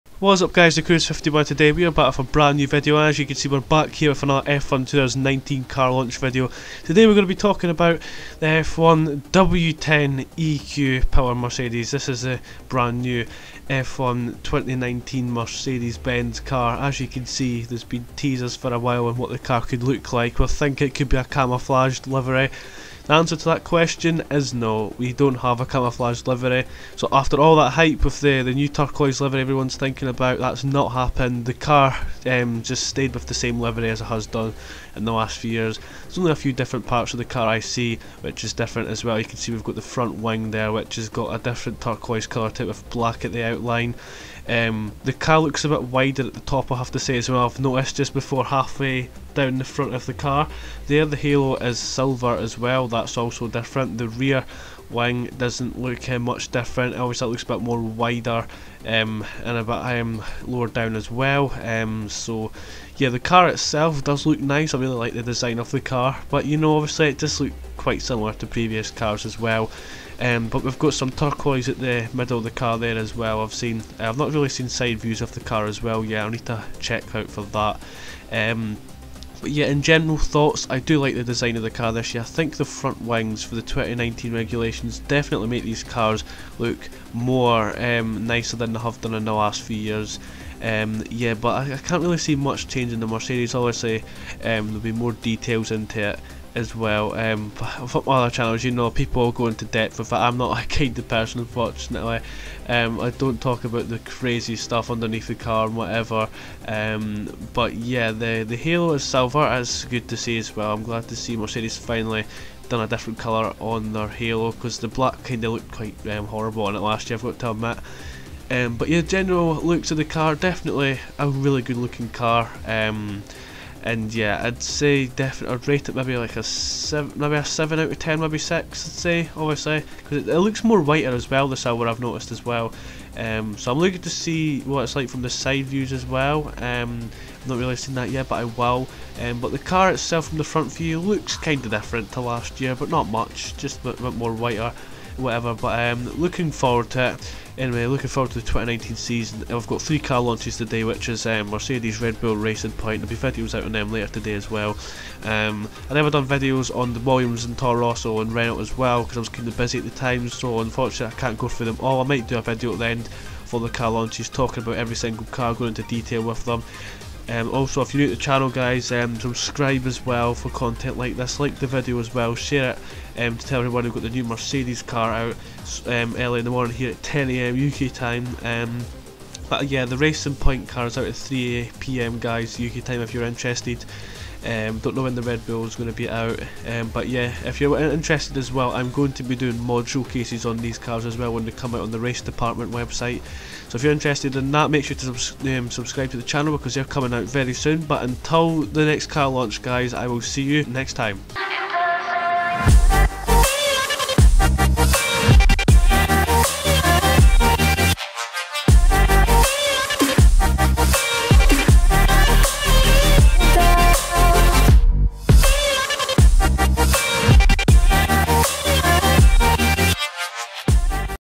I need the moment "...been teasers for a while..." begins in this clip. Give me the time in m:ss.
0:17.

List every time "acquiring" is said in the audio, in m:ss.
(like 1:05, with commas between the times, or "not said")
not said.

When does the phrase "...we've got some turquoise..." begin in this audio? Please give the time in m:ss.
1:10.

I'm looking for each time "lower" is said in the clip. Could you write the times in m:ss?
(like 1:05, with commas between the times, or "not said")
1:00.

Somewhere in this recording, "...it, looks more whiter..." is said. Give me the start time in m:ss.
2:10.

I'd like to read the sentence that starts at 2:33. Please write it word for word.
There'll be videos out on them later today as well.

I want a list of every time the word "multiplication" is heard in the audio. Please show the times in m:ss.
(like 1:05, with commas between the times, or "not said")
not said.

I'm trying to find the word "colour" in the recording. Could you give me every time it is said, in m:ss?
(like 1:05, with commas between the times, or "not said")
0:42, 1:53.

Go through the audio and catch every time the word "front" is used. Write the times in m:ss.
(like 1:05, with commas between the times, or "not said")
0:39, 0:49, 1:22, 2:20.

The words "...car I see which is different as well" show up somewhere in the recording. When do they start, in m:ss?
0:37.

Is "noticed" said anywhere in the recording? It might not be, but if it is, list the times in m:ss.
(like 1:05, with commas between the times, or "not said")
0:47, 2:11.